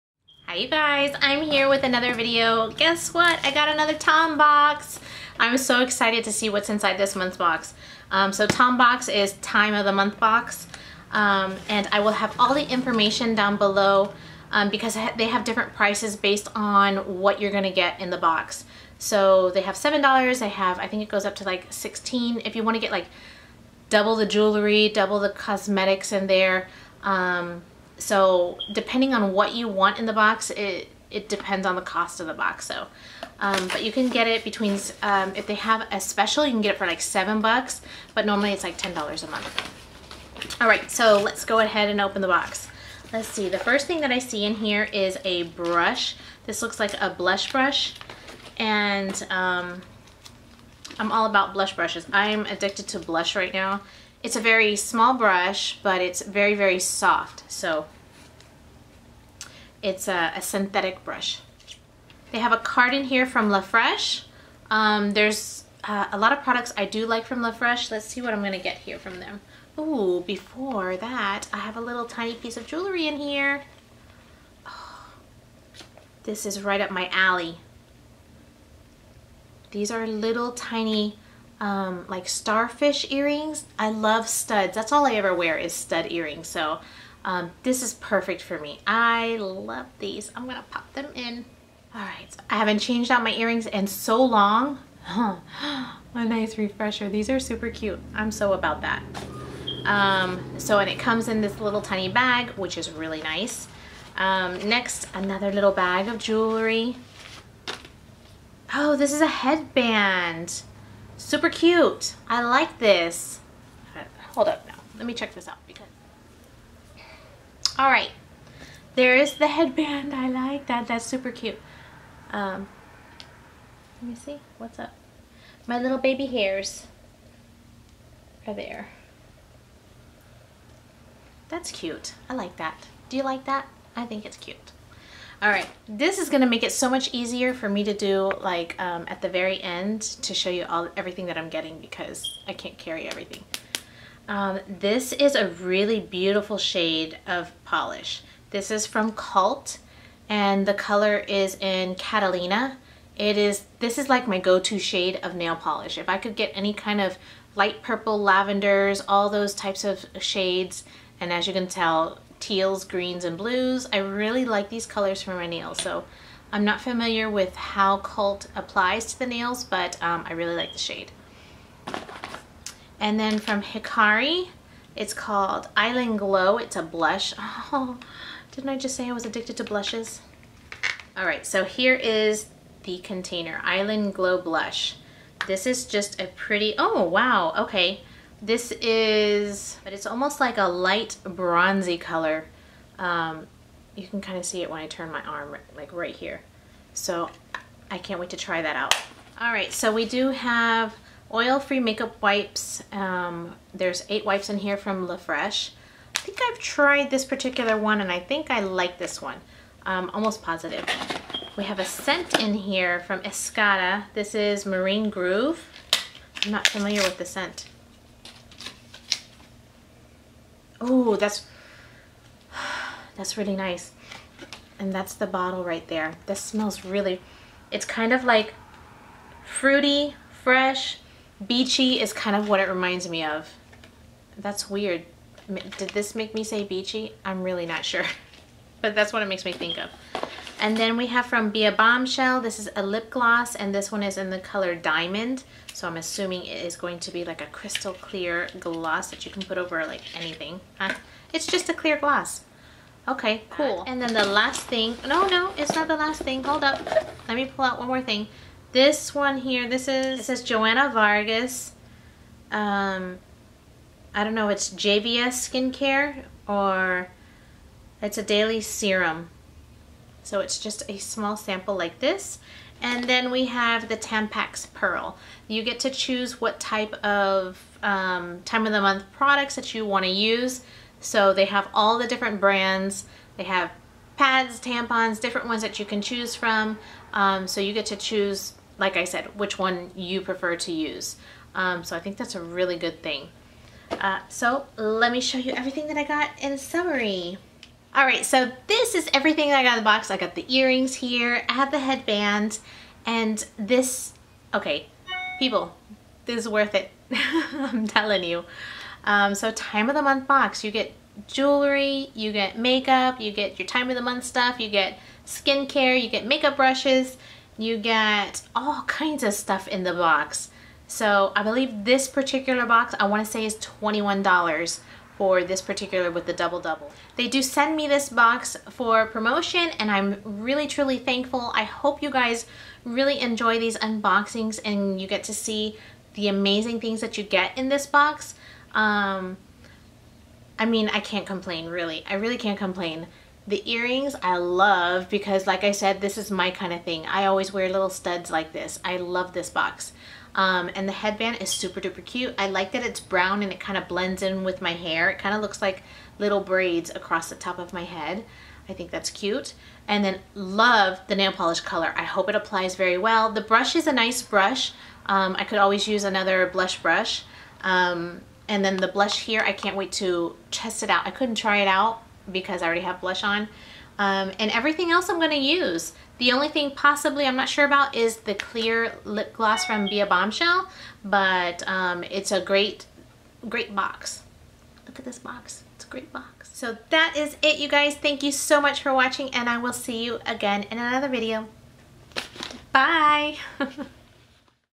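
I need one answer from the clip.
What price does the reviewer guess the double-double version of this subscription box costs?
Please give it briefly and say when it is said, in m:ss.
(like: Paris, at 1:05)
$21, at 5:23.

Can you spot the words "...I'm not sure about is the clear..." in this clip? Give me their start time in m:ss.
6:17.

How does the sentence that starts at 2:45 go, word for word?
So I'm not familiar with how Cult applies to the nails, but um, I really like the shade.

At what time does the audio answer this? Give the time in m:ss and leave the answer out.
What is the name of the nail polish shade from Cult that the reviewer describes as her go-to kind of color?
2:31.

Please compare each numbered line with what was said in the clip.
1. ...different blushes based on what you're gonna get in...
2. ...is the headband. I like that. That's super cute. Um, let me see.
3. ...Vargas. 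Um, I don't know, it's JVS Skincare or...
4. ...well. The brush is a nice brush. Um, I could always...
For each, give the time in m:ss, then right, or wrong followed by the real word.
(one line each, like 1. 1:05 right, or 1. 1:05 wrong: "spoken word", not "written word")
1. 0:15 wrong: "prices", not "blushes"
2. 1:59 right
3. 4:20 right
4. 6:02 right.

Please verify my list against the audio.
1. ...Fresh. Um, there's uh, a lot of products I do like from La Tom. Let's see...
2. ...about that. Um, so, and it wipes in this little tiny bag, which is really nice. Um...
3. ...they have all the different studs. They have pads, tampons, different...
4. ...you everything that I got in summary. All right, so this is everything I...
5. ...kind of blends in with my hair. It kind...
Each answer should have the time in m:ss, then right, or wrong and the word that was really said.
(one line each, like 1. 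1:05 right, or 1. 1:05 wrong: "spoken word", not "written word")
1. 1:03 wrong: "Fresh", not "Tom"
2. 1:38 wrong: "comes", not "wipes"
3. 4:41 wrong: "brands", not "studs"
4. 4:55 right
5. 5:53 right.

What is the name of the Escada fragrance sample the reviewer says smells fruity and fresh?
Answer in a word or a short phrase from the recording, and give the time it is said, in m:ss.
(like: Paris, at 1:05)
Marine Groove, at 3:34.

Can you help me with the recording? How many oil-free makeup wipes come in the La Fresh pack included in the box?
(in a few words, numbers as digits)
8.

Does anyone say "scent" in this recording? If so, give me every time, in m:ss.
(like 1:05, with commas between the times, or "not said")
3:31, 3:37.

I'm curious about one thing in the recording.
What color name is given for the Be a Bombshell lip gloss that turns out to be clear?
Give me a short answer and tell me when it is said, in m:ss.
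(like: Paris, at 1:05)
Diamond, at 4:04.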